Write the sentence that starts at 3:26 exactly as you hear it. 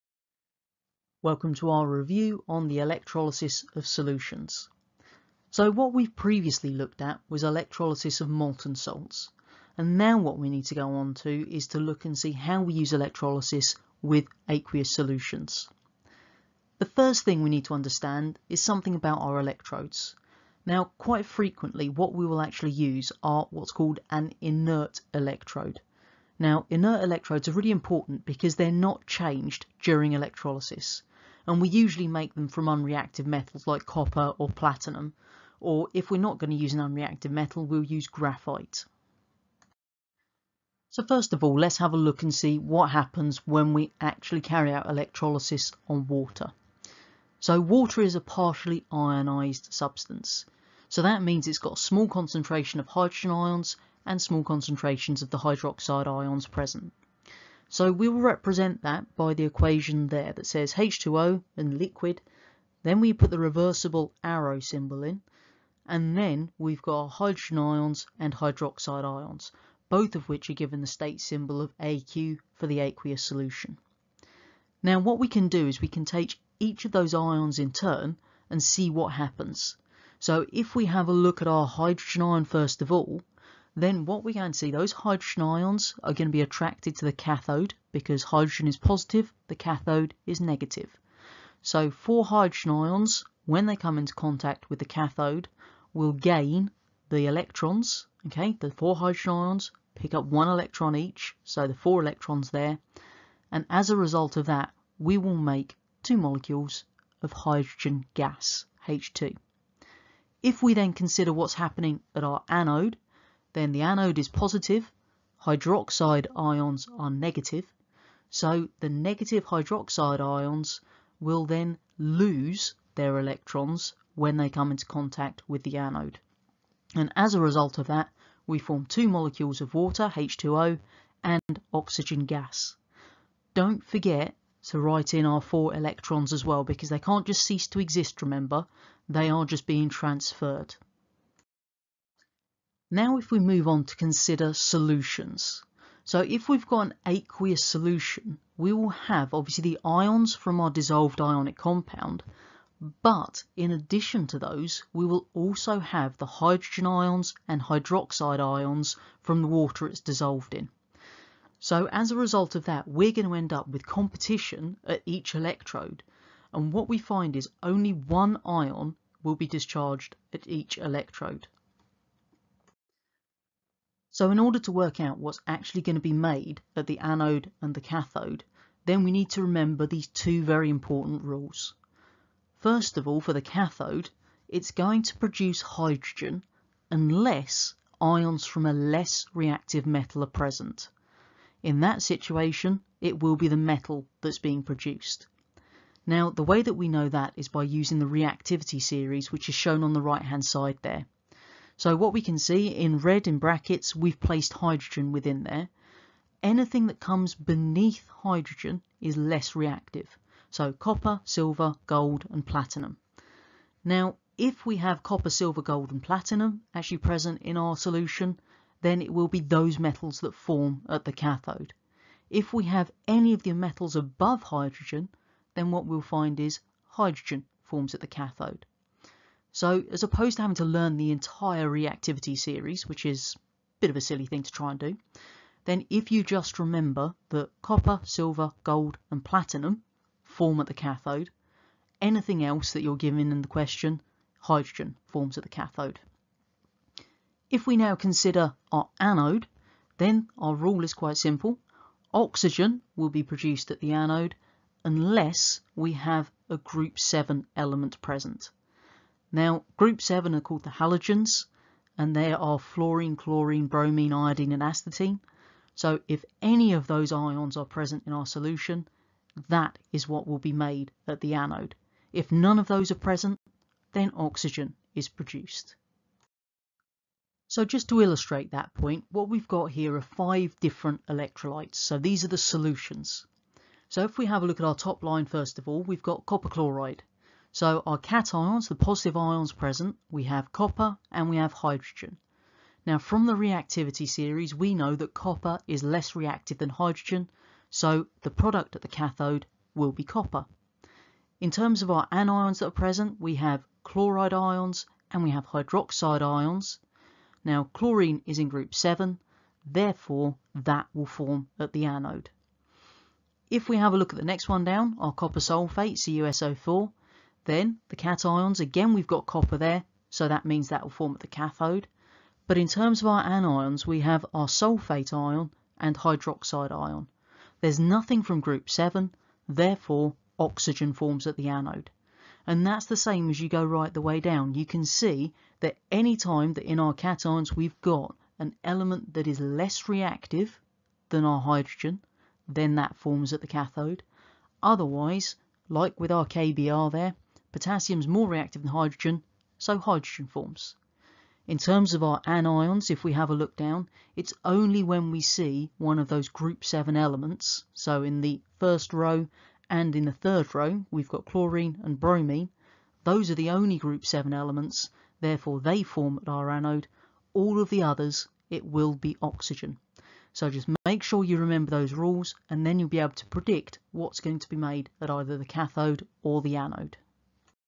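Anything that comes beneath hydrogen is less reactive.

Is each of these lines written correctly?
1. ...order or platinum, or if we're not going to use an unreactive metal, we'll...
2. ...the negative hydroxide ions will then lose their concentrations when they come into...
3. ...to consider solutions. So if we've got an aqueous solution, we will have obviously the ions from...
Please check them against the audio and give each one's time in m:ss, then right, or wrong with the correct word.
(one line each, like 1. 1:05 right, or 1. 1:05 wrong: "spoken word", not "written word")
1. 0:33 wrong: "copper", not "order"
2. 1:58 wrong: "electrons", not "concentrations"
3. 2:23 right.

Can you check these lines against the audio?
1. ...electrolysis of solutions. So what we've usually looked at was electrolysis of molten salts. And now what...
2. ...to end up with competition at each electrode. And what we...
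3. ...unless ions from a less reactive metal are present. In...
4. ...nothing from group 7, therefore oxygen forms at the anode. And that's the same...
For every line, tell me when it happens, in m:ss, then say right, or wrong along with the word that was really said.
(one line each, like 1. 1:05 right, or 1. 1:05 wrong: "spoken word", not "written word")
1. 0:02 wrong: "previously", not "usually"
2. 2:43 right
3. 3:06 right
4. 5:27 right.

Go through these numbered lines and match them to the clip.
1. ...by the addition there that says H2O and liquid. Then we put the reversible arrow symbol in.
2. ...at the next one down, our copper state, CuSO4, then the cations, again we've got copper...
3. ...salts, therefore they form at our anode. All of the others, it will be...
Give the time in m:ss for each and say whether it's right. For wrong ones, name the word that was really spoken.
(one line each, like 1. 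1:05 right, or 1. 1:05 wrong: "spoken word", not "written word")
1. 0:59 wrong: "equation", not "addition"
2. 5:14 wrong: "sulfate", not "state"
3. 6:04 wrong: "elements", not "salts".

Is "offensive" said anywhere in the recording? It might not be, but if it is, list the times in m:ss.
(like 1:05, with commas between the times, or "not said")
not said.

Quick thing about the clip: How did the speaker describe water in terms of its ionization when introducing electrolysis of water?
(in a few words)
Partially ionized.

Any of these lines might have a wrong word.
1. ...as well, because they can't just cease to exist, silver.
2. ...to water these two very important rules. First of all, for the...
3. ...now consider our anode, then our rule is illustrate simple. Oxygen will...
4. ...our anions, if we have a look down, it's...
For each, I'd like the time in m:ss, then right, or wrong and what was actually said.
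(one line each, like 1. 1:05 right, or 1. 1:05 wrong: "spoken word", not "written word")
1. 2:16 wrong: "remember", not "silver"
2. 2:59 wrong: "remember", not "water"
3. 4:07 wrong: "quite", not "illustrate"
4. 5:52 right.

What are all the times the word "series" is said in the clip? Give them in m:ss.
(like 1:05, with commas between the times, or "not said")
3:18, 3:52, 4:54.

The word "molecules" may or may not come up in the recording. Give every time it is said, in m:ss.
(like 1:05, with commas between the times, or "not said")
1:46, 2:09.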